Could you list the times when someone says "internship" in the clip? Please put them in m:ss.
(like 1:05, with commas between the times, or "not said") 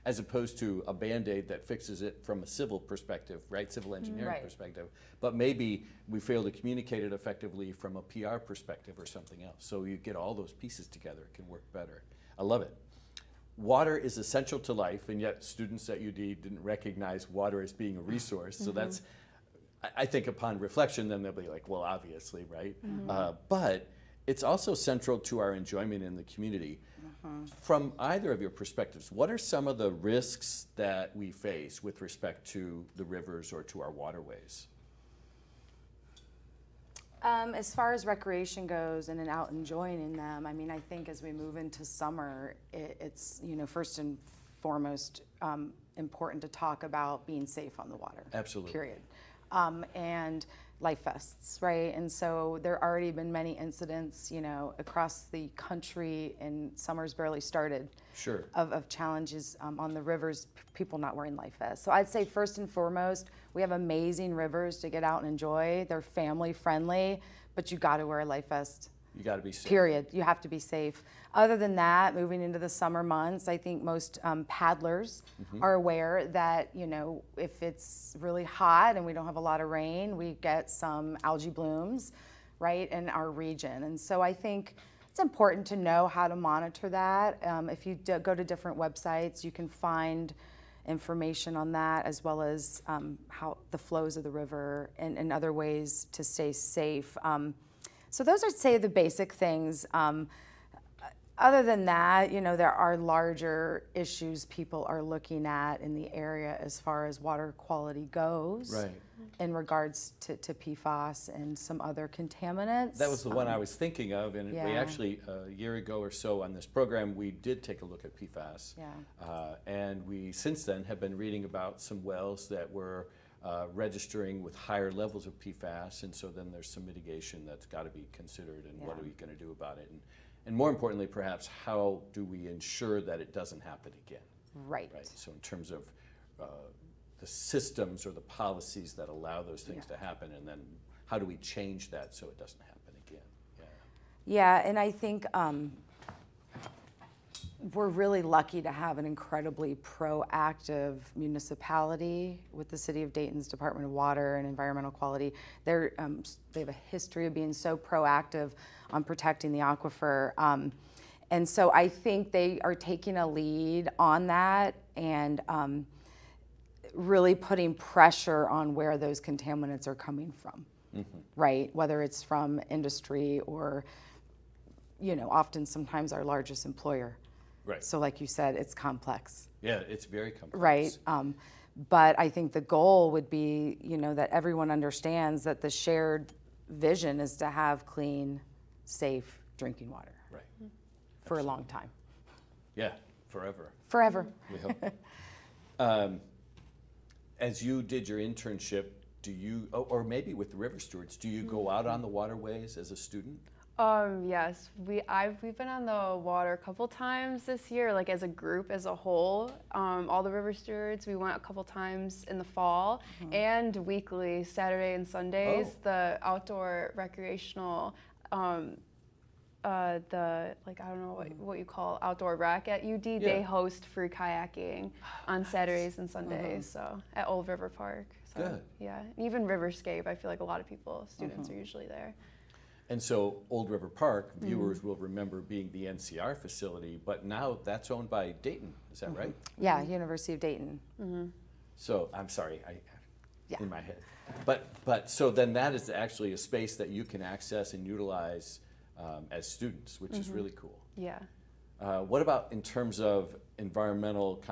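3:18.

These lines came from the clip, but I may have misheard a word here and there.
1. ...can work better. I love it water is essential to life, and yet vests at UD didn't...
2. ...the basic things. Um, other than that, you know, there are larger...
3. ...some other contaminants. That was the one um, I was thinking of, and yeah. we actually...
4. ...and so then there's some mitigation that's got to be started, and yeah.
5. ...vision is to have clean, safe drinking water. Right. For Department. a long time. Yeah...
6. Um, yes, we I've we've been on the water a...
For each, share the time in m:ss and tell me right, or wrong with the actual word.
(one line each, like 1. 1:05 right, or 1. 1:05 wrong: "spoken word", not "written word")
1. 0:11 wrong: "students", not "vests"
2. 1:38 right
3. 1:51 right
4. 2:06 wrong: "considered", not "started"
5. 3:06 wrong: "Absolutely", not "Department"
6. 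3:23 right.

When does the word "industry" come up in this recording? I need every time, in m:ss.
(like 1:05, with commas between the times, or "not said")
2:52.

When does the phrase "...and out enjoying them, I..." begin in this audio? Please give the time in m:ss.
0:39.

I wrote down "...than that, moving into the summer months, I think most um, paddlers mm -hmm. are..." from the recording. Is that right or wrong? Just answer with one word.
right.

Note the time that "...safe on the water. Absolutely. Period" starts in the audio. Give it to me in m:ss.
0:47.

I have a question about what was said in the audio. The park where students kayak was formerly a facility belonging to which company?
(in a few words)
NCR.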